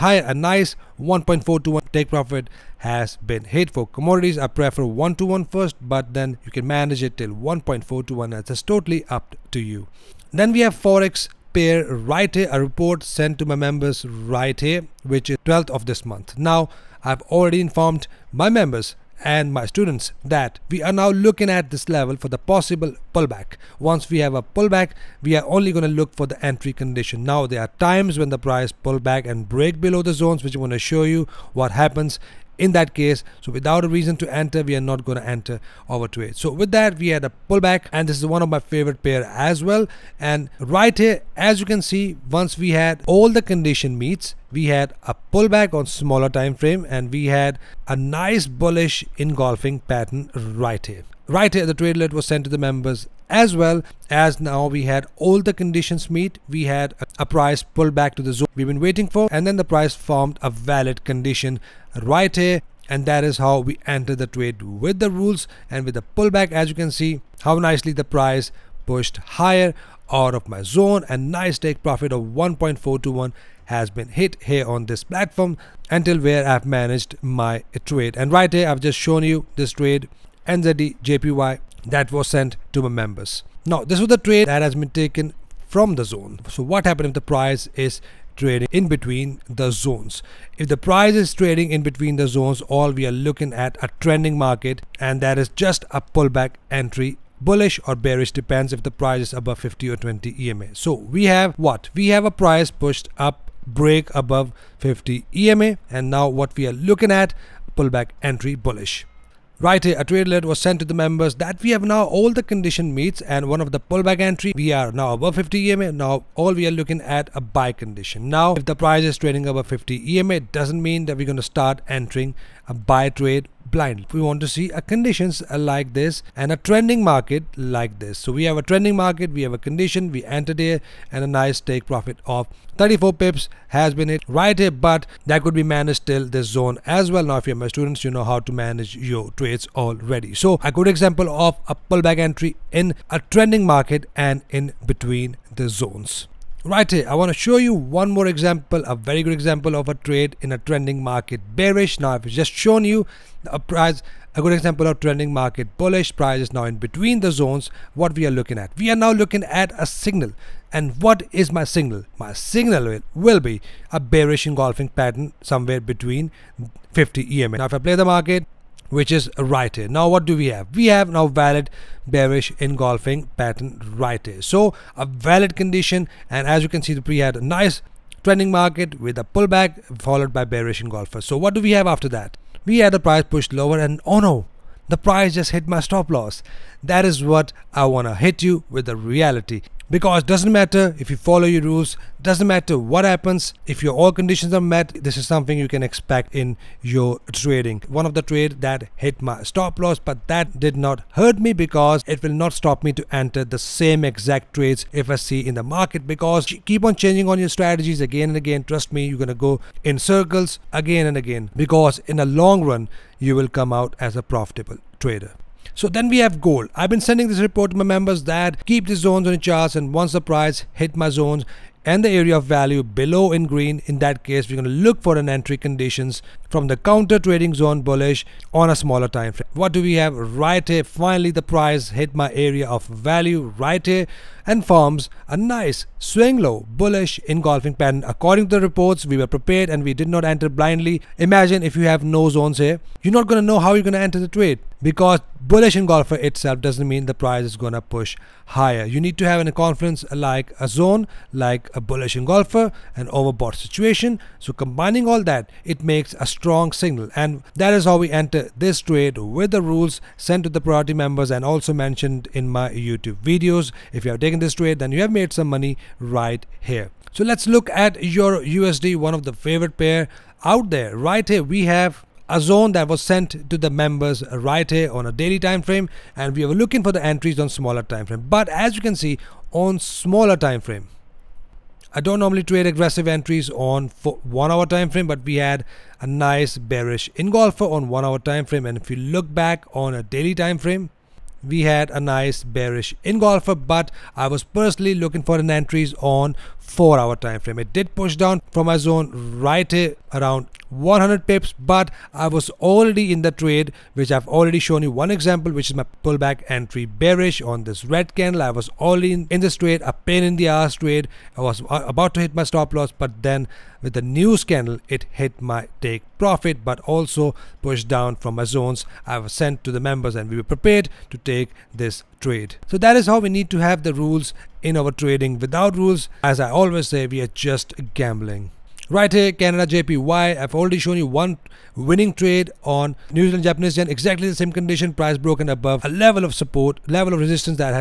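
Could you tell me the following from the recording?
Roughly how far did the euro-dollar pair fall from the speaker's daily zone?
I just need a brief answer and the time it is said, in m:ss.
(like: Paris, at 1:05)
100 pips, at 5:00.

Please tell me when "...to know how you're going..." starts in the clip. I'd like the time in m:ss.
4:03.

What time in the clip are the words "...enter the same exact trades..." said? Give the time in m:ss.
3:23.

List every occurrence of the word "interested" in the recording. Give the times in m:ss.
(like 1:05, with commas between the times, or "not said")
not said.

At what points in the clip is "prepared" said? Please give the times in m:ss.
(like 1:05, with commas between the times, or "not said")
3:59, 5:20.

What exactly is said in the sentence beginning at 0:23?
Once we have a pullback, we are only going to look for the entry condition.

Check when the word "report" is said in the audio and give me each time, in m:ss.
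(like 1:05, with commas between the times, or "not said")
0:12, 3:37, 3:58.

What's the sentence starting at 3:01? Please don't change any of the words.
So what do we have after that?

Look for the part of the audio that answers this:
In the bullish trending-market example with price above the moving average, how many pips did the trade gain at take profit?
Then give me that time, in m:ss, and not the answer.
2:12.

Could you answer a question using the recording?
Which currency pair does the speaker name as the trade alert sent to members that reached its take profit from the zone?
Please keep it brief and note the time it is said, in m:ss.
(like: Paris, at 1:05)
NZD-JPY, at 1:20.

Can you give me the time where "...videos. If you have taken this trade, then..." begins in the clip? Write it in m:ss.
4:23.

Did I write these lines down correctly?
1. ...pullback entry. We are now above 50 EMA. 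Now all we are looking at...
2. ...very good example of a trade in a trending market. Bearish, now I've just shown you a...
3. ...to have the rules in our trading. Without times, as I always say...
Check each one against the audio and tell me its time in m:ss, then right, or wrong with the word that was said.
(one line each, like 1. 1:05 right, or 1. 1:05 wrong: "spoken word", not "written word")
1. 1:53 right
2. 2:28 right
3. 5:23 wrong: "rules", not "times".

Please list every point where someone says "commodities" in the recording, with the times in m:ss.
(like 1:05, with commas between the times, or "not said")
0:03.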